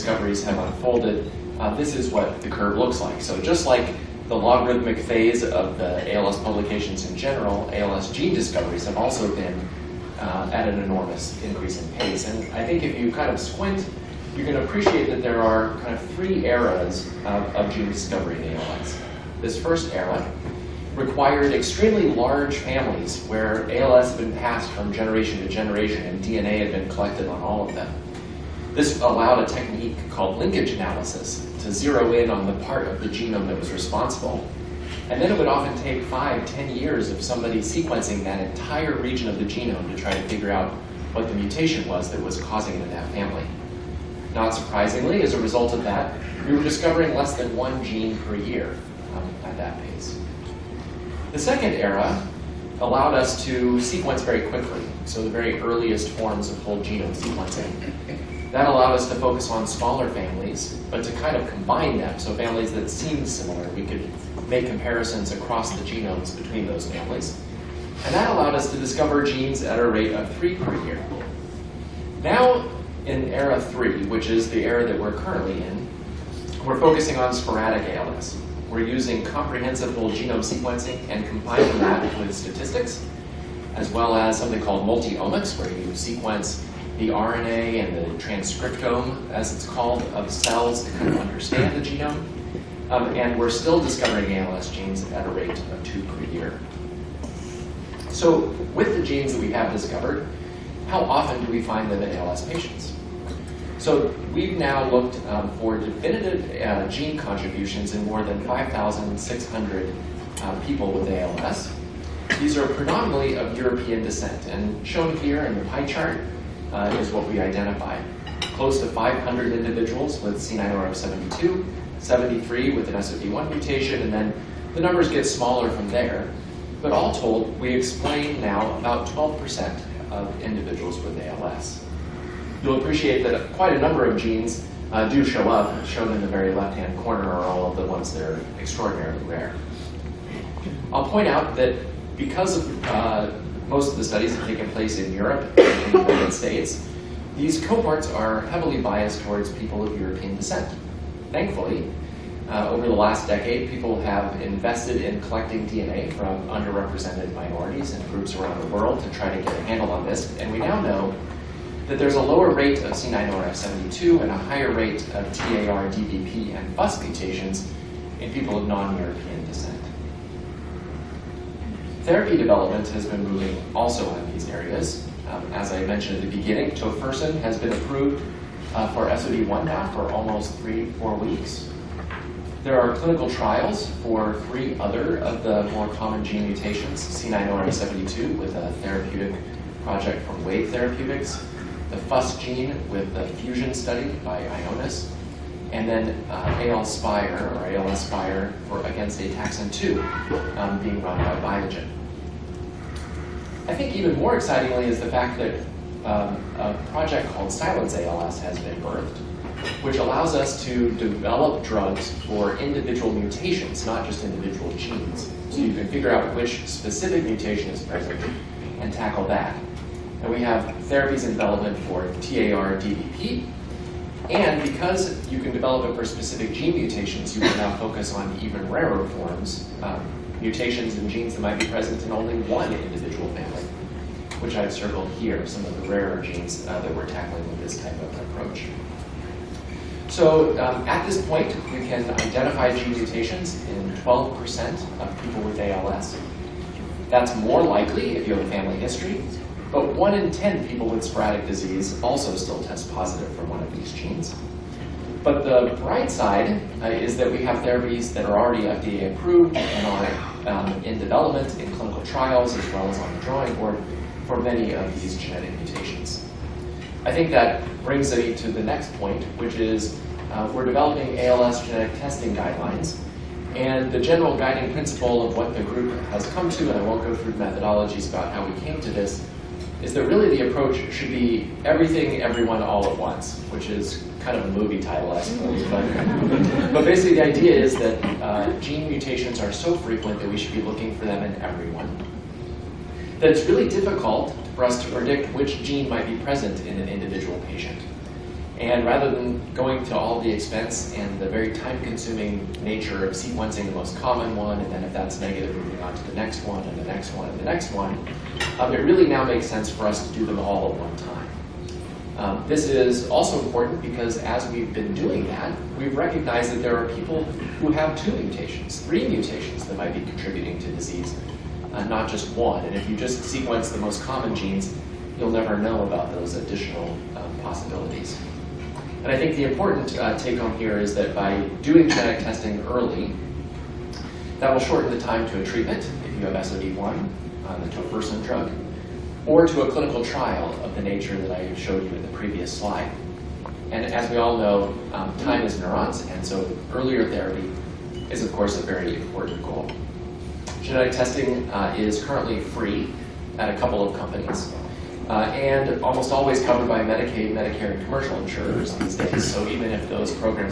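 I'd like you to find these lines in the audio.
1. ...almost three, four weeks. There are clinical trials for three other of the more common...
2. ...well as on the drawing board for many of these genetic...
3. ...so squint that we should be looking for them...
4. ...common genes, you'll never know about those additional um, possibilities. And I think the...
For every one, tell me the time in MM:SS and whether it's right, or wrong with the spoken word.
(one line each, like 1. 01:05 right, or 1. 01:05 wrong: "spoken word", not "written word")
1. 03:00 right
2. 04:22 right
3. 04:49 wrong: "frequent", not "squint"
4. 05:24 right.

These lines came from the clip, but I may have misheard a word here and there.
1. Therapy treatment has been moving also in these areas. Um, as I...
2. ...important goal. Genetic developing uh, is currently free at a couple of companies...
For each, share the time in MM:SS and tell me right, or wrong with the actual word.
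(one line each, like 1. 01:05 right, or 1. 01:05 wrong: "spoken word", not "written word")
1. 02:52 wrong: "development", not "treatment"
2. 05:48 wrong: "testing", not "developing".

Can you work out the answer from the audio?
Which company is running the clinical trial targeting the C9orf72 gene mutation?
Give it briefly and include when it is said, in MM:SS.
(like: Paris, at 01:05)
Wave Therapeutics, at 03:10.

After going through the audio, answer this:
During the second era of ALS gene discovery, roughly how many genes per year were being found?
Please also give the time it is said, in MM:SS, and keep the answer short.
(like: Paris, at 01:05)
3, at 01:10.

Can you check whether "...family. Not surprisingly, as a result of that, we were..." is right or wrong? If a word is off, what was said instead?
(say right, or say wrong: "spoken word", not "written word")
right.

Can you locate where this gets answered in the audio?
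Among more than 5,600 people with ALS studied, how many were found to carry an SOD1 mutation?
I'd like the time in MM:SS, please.
02:01.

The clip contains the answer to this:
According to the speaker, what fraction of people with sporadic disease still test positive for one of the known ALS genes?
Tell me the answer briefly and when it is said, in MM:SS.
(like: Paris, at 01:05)
1 in 10, at 04:09.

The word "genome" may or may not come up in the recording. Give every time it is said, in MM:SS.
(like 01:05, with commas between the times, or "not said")
00:33, 00:39, 00:56, 01:05, 01:20, 01:31.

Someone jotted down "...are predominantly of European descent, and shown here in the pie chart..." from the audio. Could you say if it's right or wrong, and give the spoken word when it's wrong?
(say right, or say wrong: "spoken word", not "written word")
right.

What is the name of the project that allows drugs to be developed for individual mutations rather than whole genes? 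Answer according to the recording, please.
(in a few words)
Silence ALS.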